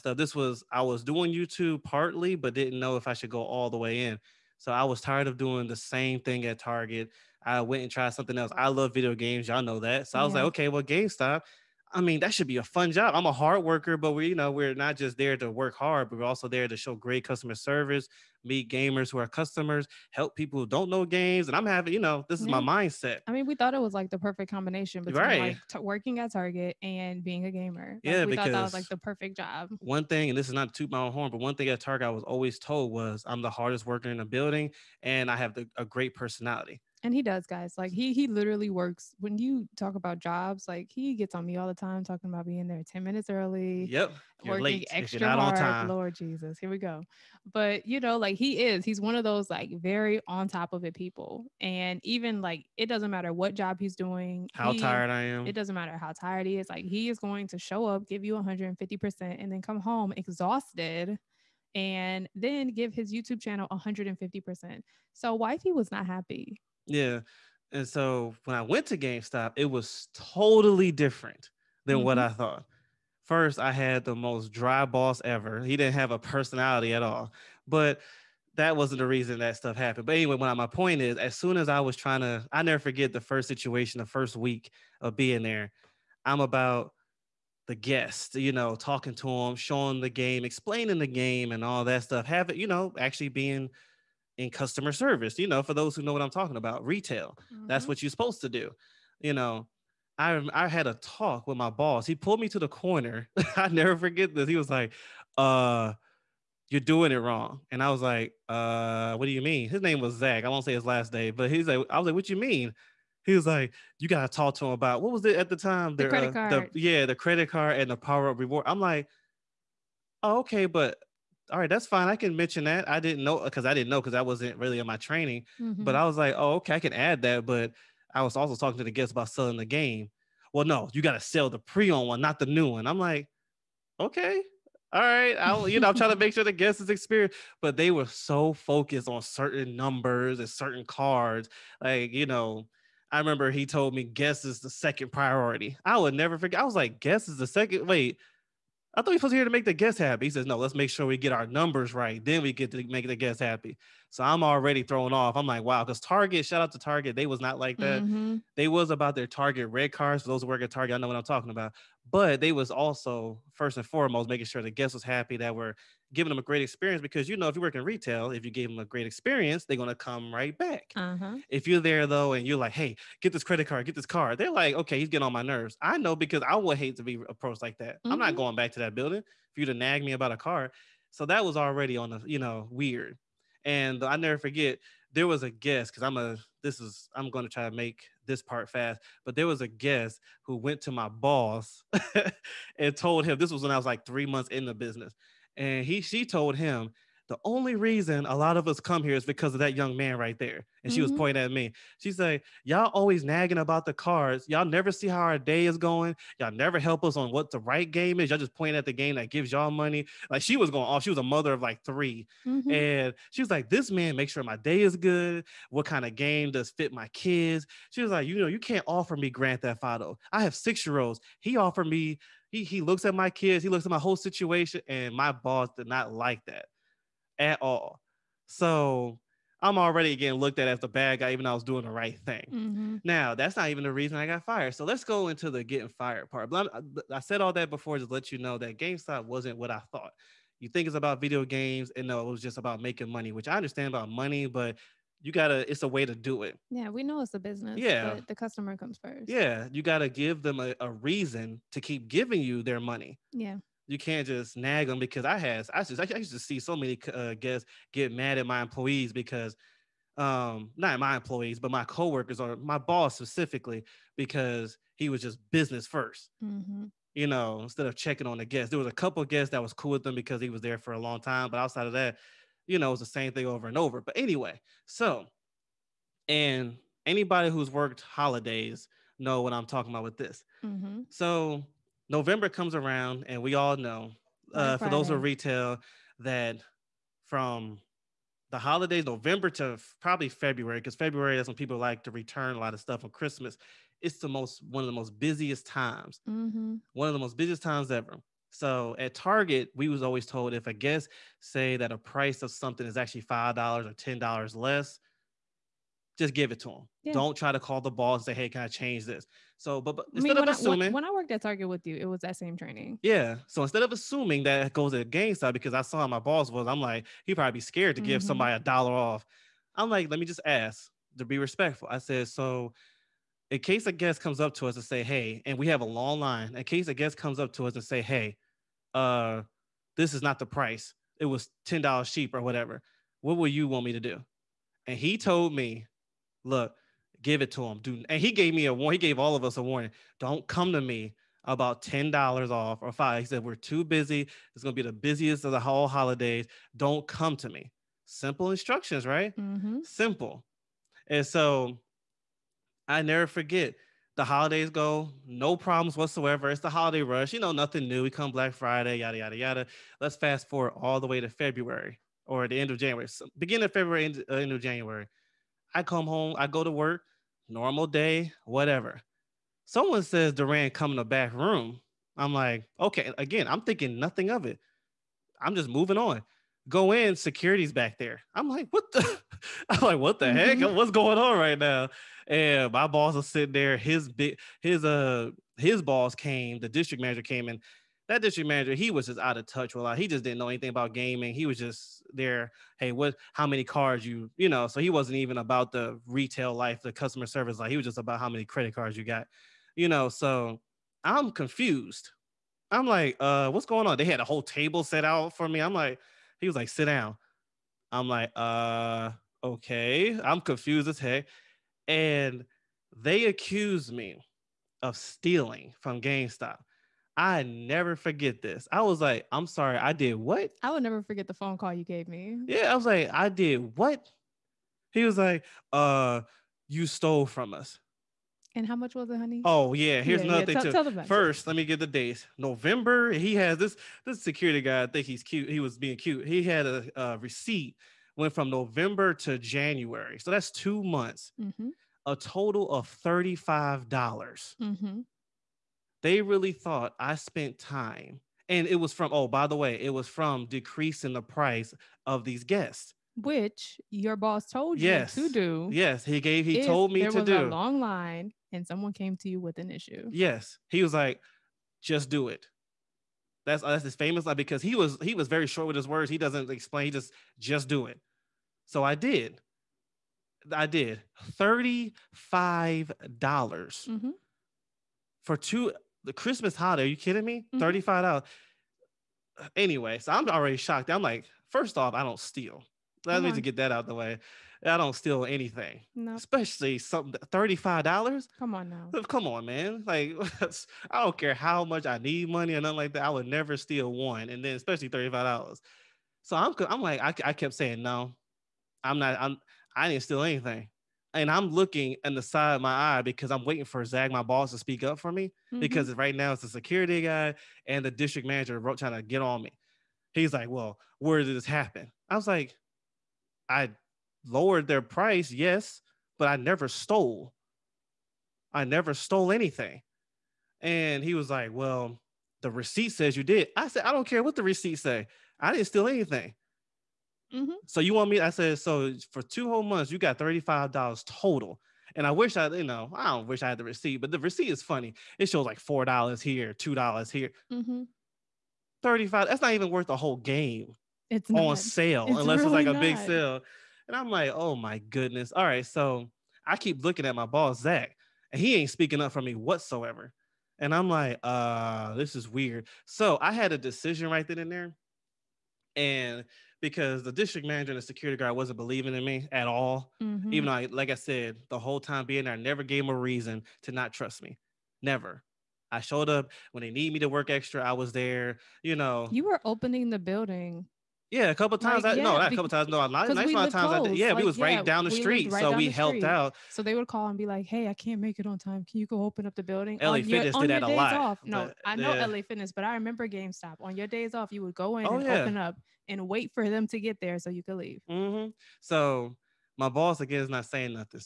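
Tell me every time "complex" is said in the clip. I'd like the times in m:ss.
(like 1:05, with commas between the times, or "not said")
not said.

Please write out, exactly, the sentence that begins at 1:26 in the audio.
I'm about the guest, you know, talking to them, showing the game, explaining the game, and all that stuff.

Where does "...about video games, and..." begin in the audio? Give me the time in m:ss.
4:00.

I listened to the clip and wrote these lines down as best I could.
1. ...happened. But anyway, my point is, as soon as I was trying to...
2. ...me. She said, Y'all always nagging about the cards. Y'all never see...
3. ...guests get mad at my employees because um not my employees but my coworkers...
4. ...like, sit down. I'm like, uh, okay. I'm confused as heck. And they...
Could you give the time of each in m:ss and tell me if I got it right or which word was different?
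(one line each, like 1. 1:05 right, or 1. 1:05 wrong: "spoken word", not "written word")
1. 1:19 right
2. 3:21 right
3. 4:17 right
4. 6:46 right.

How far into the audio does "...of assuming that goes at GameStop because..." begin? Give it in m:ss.
5:13.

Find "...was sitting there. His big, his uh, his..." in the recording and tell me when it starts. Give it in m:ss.
6:23.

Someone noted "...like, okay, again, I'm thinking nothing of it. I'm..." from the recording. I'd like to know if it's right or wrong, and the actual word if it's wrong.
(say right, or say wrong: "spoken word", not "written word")
right.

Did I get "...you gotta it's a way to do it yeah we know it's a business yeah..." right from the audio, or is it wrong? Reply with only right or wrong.
right.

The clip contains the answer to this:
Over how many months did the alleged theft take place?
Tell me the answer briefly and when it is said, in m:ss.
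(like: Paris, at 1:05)
2, at 7:20.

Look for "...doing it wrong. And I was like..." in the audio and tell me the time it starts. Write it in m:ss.
1:46.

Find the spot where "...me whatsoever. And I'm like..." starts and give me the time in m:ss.
9:09.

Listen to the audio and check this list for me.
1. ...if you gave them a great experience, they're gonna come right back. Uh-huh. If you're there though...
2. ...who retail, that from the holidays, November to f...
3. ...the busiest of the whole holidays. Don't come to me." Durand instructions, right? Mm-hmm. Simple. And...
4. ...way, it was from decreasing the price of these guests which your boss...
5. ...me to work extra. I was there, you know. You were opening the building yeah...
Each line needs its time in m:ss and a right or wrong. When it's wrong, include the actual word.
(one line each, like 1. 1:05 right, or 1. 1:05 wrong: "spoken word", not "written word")
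1. 2:48 right
2. 4:45 right
3. 5:44 wrong: "Simple", not "Durand"
4. 7:29 right
5. 9:26 right.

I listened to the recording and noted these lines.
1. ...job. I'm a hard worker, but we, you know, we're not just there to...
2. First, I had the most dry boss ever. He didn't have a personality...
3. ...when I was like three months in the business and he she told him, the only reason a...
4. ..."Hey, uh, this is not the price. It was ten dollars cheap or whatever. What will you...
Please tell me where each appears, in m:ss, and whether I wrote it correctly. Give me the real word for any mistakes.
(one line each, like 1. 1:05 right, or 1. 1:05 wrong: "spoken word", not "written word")
1. 0:12 right
2. 1:13 right
3. 3:13 right
4. 5:28 right.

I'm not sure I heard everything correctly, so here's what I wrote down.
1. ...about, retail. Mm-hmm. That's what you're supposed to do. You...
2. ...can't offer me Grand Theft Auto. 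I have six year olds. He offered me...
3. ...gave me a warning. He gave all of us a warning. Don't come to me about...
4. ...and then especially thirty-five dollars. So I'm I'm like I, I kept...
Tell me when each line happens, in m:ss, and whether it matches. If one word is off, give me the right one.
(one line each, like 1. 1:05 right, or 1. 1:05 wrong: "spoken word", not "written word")
1. 1:36 right
2. 3:38 right
3. 5:38 right
4. 8:14 right.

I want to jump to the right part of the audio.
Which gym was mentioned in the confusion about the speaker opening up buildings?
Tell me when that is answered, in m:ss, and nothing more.
9:42.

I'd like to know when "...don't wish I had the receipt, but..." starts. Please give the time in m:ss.
8:53.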